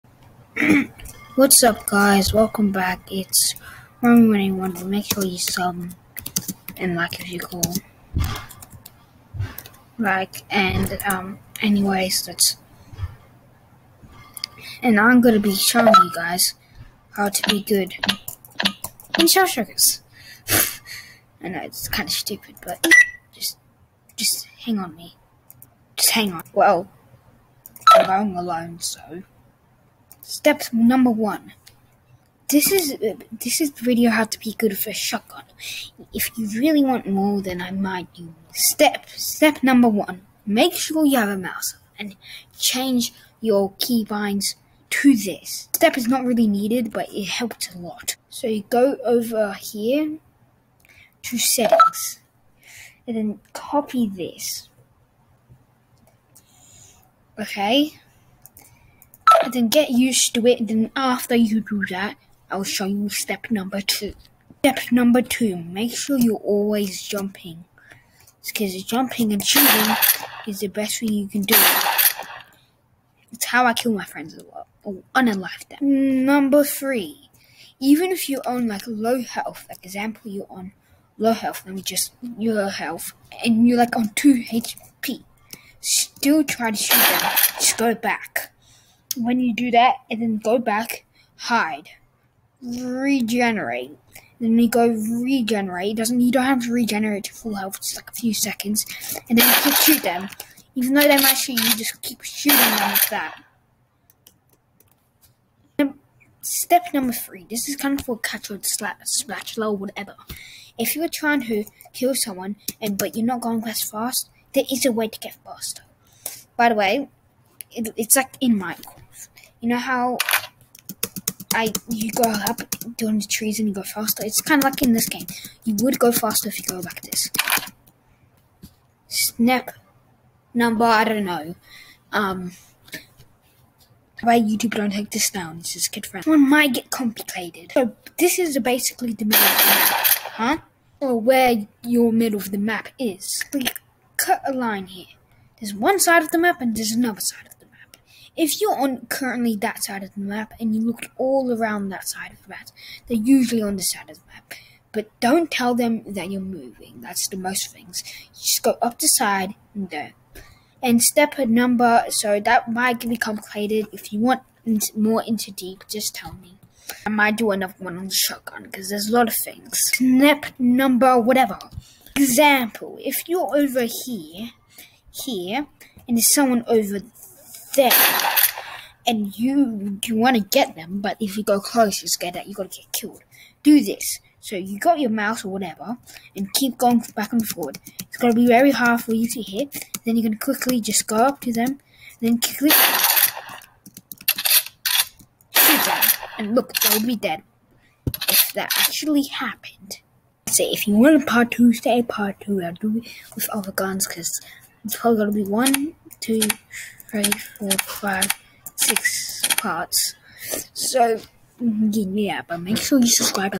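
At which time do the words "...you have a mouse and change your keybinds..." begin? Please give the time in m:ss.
0:41.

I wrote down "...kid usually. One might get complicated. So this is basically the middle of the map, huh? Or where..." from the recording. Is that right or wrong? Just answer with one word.
wrong.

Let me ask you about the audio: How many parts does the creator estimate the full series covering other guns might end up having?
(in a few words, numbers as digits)
6.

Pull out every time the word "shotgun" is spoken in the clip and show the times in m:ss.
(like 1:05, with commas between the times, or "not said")
0:34, 2:48.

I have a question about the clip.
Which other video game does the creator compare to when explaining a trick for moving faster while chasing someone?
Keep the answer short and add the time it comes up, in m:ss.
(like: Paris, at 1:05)
Minecraft, at 1:58.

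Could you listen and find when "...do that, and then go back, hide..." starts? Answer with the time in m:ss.
1:29.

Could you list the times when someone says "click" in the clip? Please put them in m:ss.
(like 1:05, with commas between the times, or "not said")
3:12.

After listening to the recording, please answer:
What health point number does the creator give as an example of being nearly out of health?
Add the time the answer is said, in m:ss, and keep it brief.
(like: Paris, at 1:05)
2, at 1:24.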